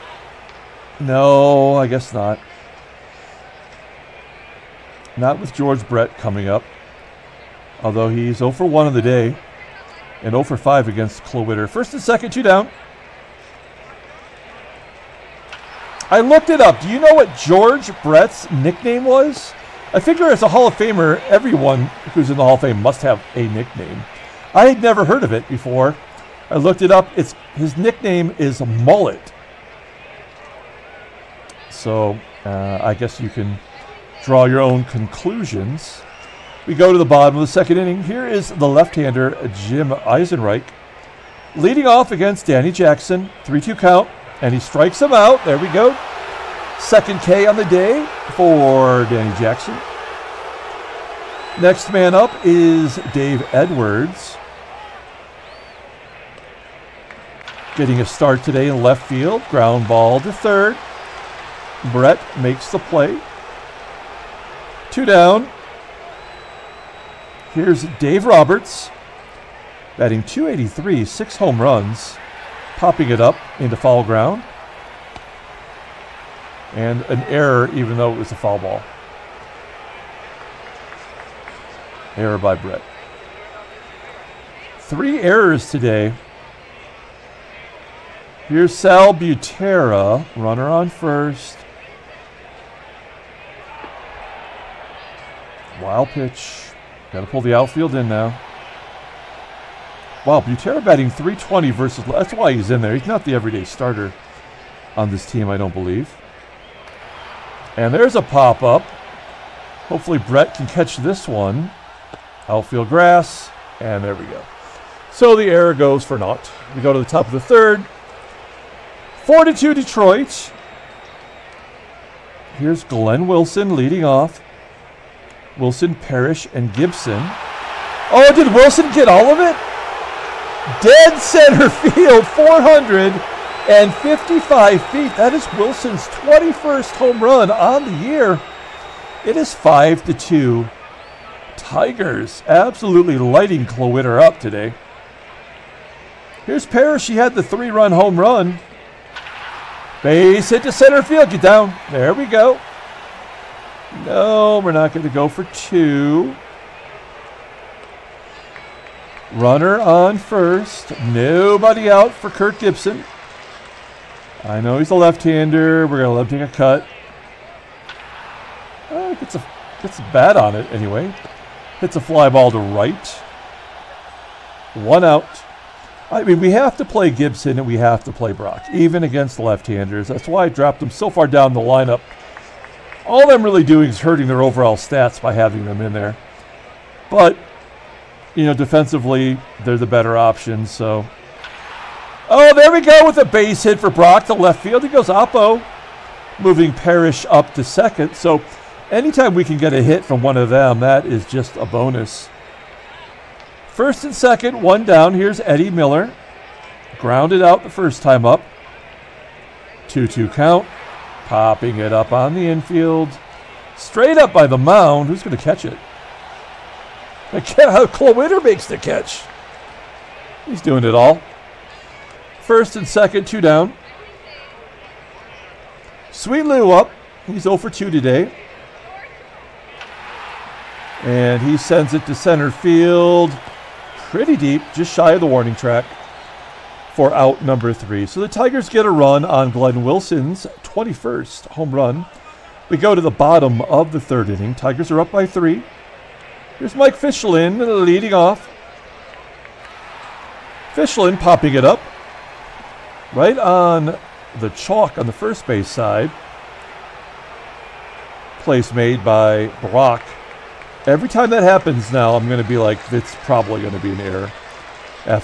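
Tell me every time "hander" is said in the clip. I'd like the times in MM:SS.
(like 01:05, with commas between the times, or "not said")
00:38, 02:44, 02:59.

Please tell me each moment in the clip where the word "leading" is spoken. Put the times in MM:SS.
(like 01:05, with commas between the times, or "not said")
00:41, 02:03, 04:07.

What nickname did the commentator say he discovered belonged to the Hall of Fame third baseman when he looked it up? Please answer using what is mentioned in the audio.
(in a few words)
Mullet.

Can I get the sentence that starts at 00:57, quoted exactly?
Getting a start today in left field.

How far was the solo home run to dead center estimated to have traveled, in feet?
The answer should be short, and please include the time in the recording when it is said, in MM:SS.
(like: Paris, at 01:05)
455, at 02:12.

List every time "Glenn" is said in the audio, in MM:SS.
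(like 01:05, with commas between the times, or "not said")
02:02, 03:59.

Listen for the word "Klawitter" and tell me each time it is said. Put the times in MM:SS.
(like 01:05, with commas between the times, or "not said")
00:11, 02:23, 03:37.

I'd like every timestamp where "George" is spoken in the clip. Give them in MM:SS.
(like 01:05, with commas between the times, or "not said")
00:05, 00:17.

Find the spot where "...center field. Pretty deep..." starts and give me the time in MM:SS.
03:52.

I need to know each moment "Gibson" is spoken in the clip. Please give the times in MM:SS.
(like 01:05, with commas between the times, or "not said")
02:06, 02:42, 02:57.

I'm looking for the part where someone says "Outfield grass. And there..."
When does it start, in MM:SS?
01:52.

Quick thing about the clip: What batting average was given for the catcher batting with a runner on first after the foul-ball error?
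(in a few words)
320.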